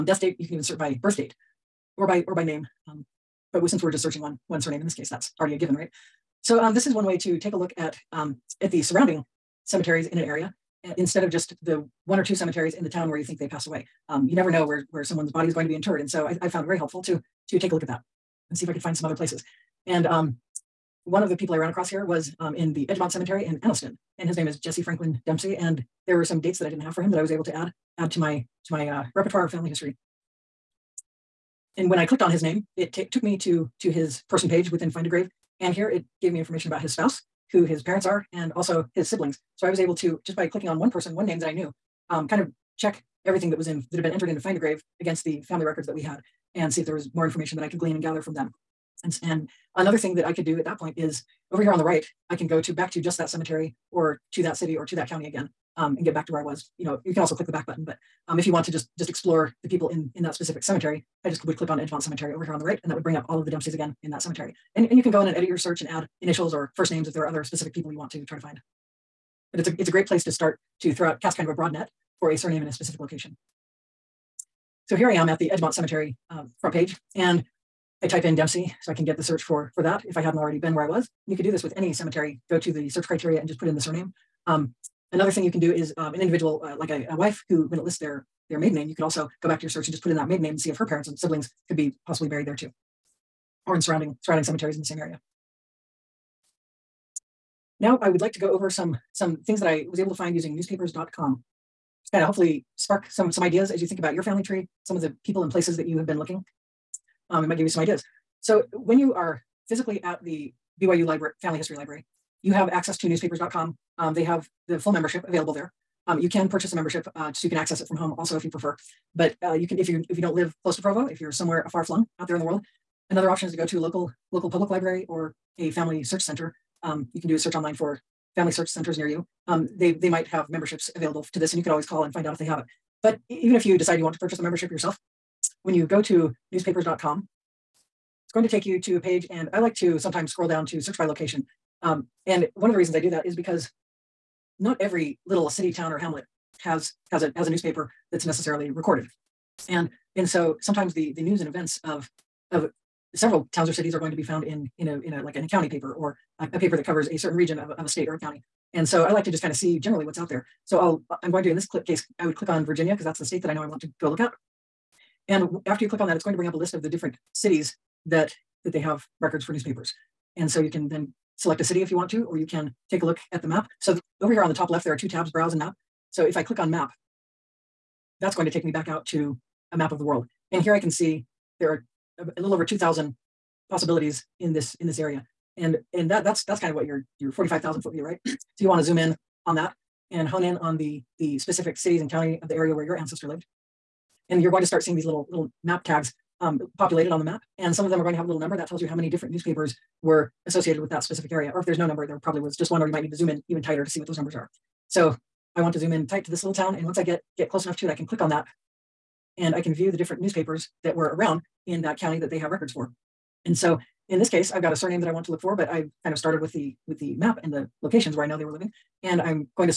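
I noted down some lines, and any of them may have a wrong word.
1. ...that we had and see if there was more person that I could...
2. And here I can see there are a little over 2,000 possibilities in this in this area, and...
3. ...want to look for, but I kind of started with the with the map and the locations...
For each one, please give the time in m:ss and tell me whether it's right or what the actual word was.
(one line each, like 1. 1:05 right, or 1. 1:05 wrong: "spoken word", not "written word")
1. 0:45 wrong: "information", not "person"
2. 3:00 right
3. 3:35 right.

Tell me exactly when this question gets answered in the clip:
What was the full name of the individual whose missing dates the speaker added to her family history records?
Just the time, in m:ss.
0:24.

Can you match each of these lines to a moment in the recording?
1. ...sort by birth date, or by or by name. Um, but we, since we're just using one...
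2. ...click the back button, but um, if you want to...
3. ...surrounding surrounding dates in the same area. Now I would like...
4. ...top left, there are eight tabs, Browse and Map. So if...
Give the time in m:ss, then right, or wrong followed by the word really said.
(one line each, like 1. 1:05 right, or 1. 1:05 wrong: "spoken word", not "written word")
1. 0:00 wrong: "searching", not "using"
2. 0:57 right
3. 1:33 wrong: "cemeteries", not "dates"
4. 2:54 wrong: "two", not "eight".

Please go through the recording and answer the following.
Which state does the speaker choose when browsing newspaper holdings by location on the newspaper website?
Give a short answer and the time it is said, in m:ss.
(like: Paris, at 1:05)
Virginia, at 2:42.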